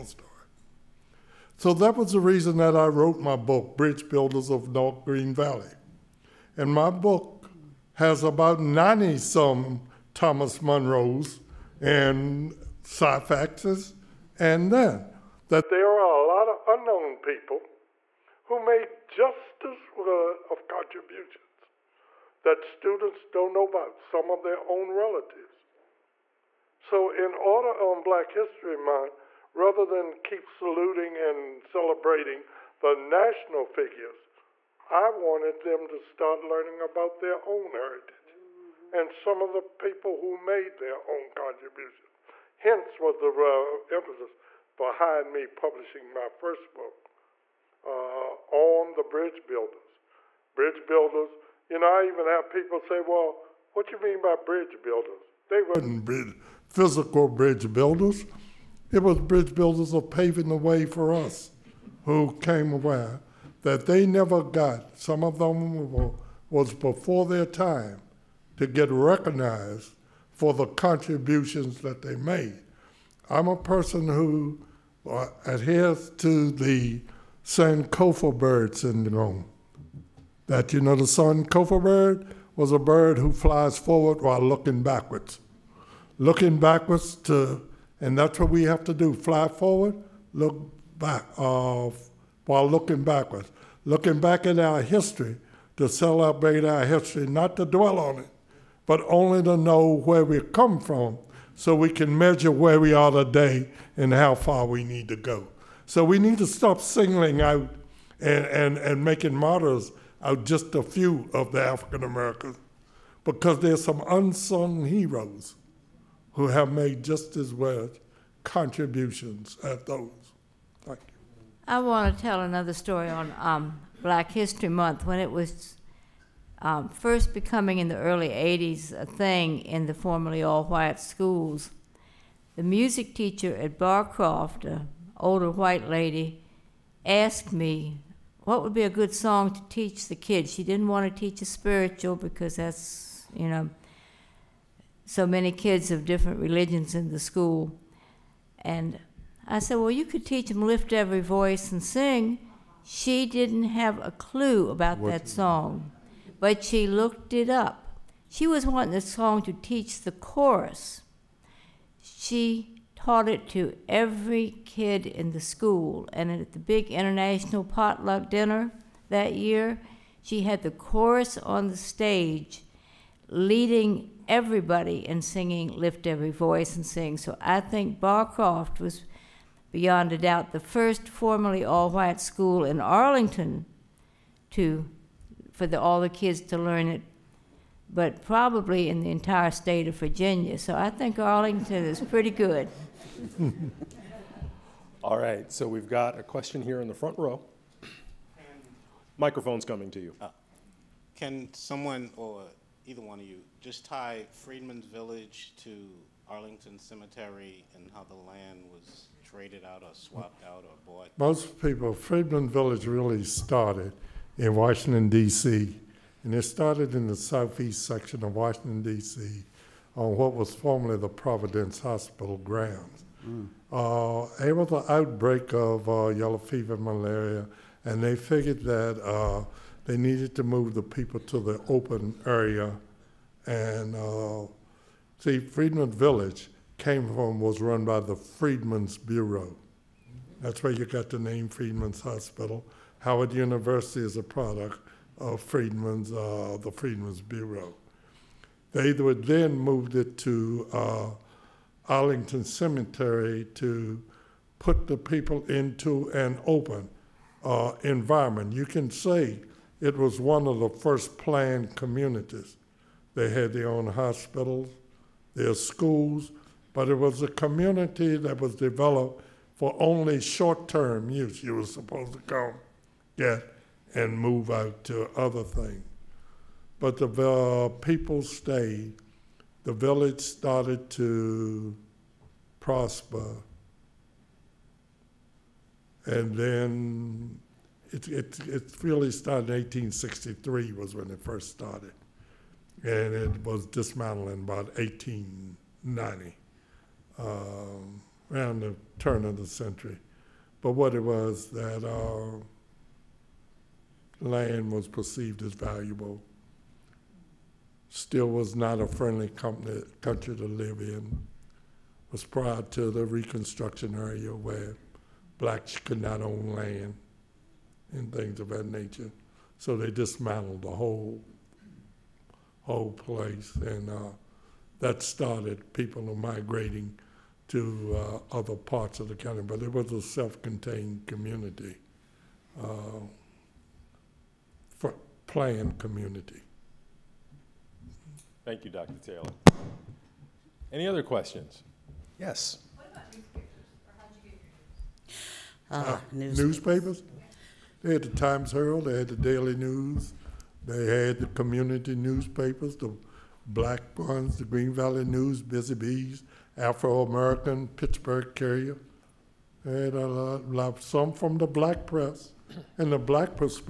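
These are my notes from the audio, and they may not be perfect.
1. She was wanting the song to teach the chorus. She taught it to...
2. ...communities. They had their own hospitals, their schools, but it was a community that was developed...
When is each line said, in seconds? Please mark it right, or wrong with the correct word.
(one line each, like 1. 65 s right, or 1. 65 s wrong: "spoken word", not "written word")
1. 158 s right
2. 261 s right.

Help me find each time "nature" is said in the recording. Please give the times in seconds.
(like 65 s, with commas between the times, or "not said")
318 s.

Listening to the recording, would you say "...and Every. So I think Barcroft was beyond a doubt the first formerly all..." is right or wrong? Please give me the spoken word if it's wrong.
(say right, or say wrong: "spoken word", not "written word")
wrong: "Sing", not "Every".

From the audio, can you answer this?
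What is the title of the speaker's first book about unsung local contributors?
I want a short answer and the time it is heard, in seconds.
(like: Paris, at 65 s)
Bridge Builders of North Green Valley, at 3 s.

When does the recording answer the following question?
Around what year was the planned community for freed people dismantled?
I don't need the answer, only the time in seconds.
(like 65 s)
294 s.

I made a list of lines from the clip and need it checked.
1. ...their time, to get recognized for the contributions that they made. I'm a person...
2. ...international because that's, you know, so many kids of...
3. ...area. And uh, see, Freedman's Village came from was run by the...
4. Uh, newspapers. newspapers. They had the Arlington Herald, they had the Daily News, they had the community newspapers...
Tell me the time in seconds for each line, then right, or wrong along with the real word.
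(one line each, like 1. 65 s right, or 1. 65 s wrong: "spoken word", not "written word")
1. 67 s right
2. 141 s wrong: "spiritual", not "international"
3. 232 s right
4. 345 s wrong: "Times", not "Arlington".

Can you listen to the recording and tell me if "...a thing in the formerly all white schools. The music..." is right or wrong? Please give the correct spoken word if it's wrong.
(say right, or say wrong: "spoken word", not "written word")
right.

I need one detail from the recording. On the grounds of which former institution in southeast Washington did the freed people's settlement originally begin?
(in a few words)
Providence Hospital.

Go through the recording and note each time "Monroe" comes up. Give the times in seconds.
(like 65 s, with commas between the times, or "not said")
10 s.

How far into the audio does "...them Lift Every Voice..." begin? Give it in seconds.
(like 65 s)
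150 s.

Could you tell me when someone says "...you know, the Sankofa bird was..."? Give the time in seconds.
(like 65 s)
80 s.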